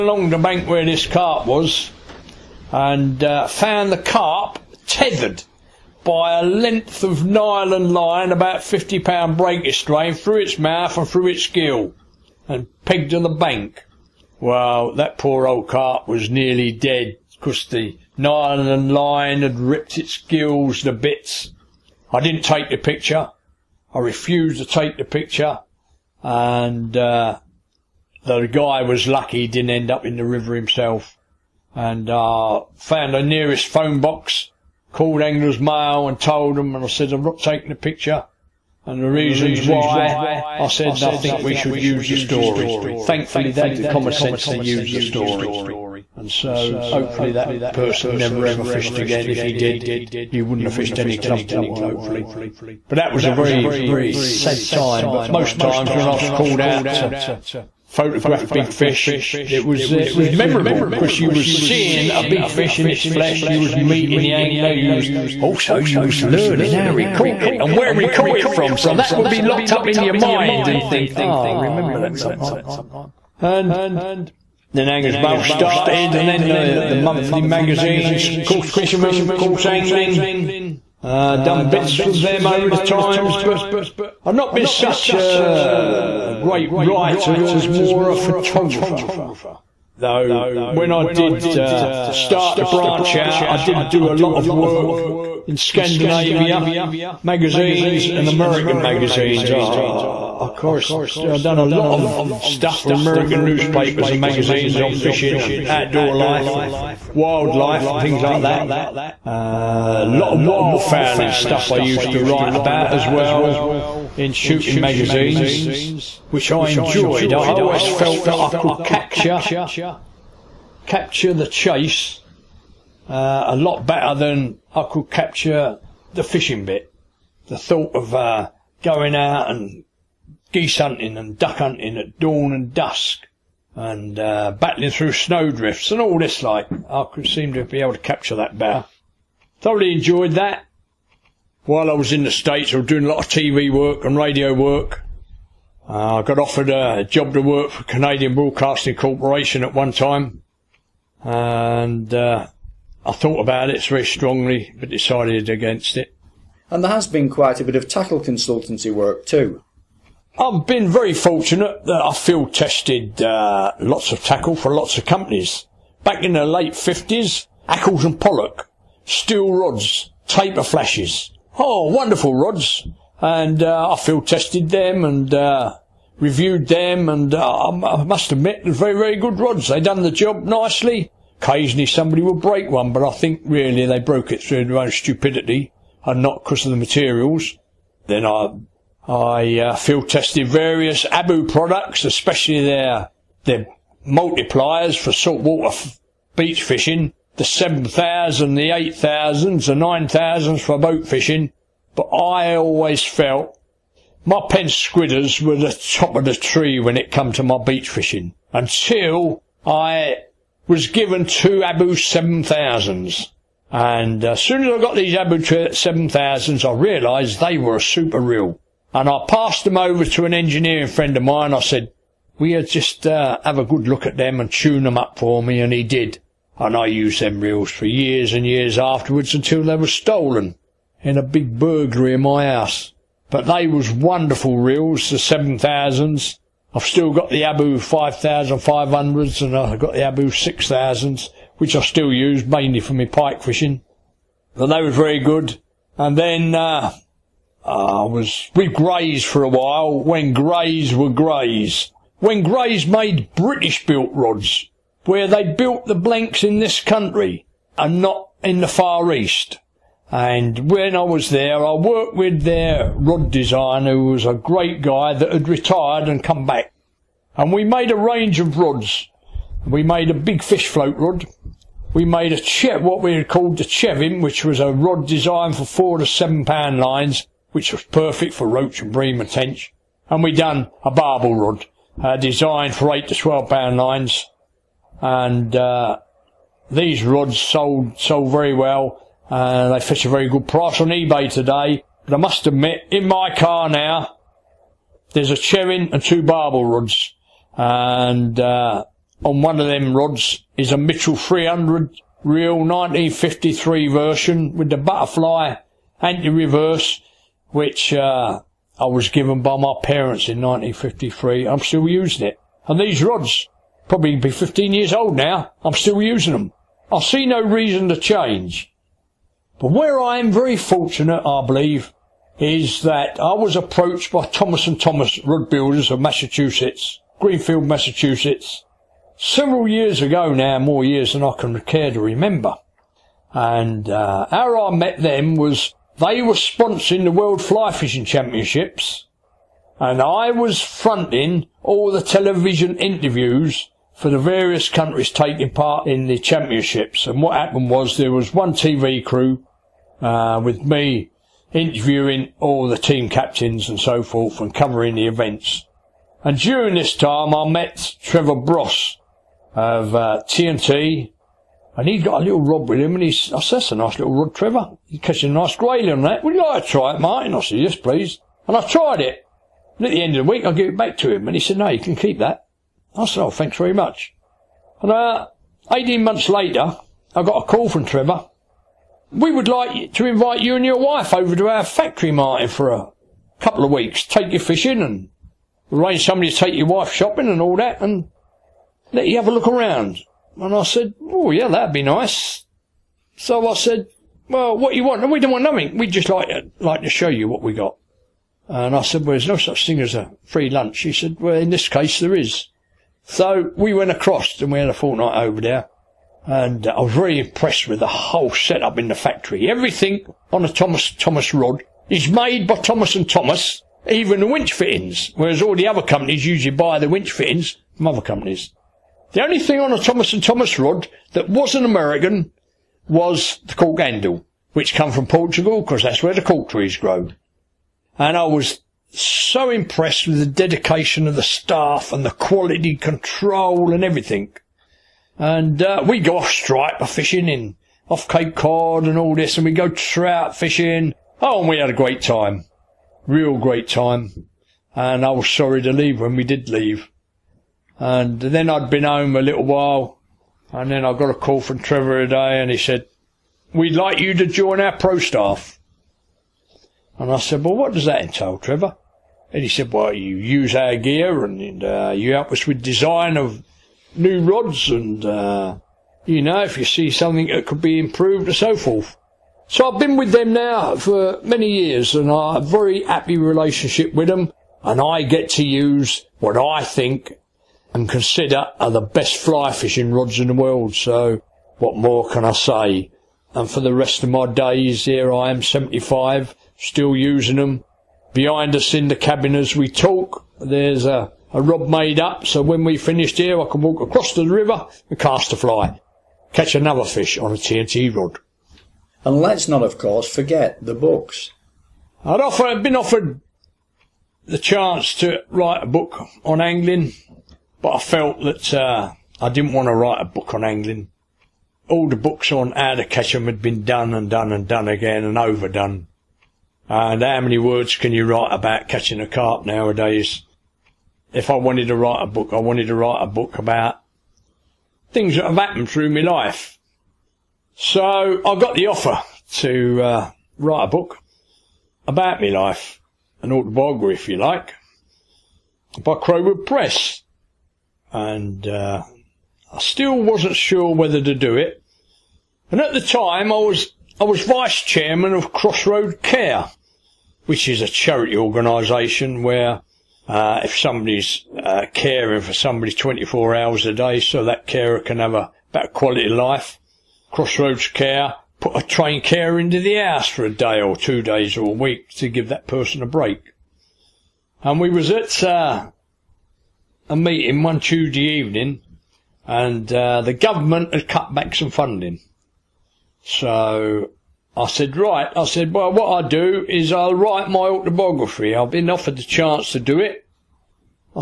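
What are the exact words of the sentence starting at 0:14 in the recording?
Well, that poor old carp was nearly dead because the Nylon and line had ripped its gills to bits.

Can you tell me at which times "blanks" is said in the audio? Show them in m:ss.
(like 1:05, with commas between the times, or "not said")
4:15.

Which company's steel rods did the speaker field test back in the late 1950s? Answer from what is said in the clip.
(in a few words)
Accles and Pollock.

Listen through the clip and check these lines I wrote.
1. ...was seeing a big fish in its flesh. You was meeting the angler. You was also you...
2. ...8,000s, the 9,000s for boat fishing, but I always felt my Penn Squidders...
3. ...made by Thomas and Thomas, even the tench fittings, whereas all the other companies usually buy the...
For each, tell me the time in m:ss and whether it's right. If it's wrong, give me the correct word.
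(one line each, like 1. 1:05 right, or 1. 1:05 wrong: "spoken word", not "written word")
1. 1:01 right
2. 3:18 right
3. 6:52 wrong: "winch", not "tench".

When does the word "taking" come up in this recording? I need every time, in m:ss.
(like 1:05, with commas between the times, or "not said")
0:37, 5:45.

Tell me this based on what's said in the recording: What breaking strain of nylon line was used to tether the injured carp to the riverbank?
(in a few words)
50 pound.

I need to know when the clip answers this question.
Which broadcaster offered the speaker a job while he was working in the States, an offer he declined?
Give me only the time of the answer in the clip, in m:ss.
2:27.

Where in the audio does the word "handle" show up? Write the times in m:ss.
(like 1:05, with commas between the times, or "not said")
7:03.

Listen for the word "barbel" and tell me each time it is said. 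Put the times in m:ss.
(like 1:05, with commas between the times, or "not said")
4:40, 4:56.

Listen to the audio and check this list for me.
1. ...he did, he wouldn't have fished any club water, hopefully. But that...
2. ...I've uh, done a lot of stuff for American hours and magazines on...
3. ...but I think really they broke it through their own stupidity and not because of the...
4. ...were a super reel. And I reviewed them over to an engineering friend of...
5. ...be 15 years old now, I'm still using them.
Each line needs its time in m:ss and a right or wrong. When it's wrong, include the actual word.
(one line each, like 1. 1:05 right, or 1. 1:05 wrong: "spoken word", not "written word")
1. 0:49 right
2. 1:41 wrong: "newspapers", not "hours"
3. 3:02 right
4. 3:37 wrong: "passed", not "reviewed"
5. 5:14 right.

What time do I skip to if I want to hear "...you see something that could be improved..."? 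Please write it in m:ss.
7:46.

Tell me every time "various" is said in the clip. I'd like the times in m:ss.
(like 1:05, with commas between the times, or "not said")
3:10, 5:44.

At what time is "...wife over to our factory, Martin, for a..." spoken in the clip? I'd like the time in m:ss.
6:20.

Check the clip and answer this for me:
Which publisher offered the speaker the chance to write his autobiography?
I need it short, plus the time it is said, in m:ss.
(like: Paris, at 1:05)
Crowood Press, at 8:55.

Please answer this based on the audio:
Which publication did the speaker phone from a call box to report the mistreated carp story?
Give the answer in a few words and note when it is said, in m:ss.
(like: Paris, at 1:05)
Angler's Mail, at 0:35.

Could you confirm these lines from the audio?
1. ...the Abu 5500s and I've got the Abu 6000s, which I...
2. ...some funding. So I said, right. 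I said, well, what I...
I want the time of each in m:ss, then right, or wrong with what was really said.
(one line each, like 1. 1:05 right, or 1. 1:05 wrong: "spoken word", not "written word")
1. 3:57 right
2. 9:31 right.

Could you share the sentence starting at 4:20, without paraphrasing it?
And when I was there, I worked with their rod designer, who was a great guy that had retired and come back.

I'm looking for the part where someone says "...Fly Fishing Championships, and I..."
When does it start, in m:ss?
5:37.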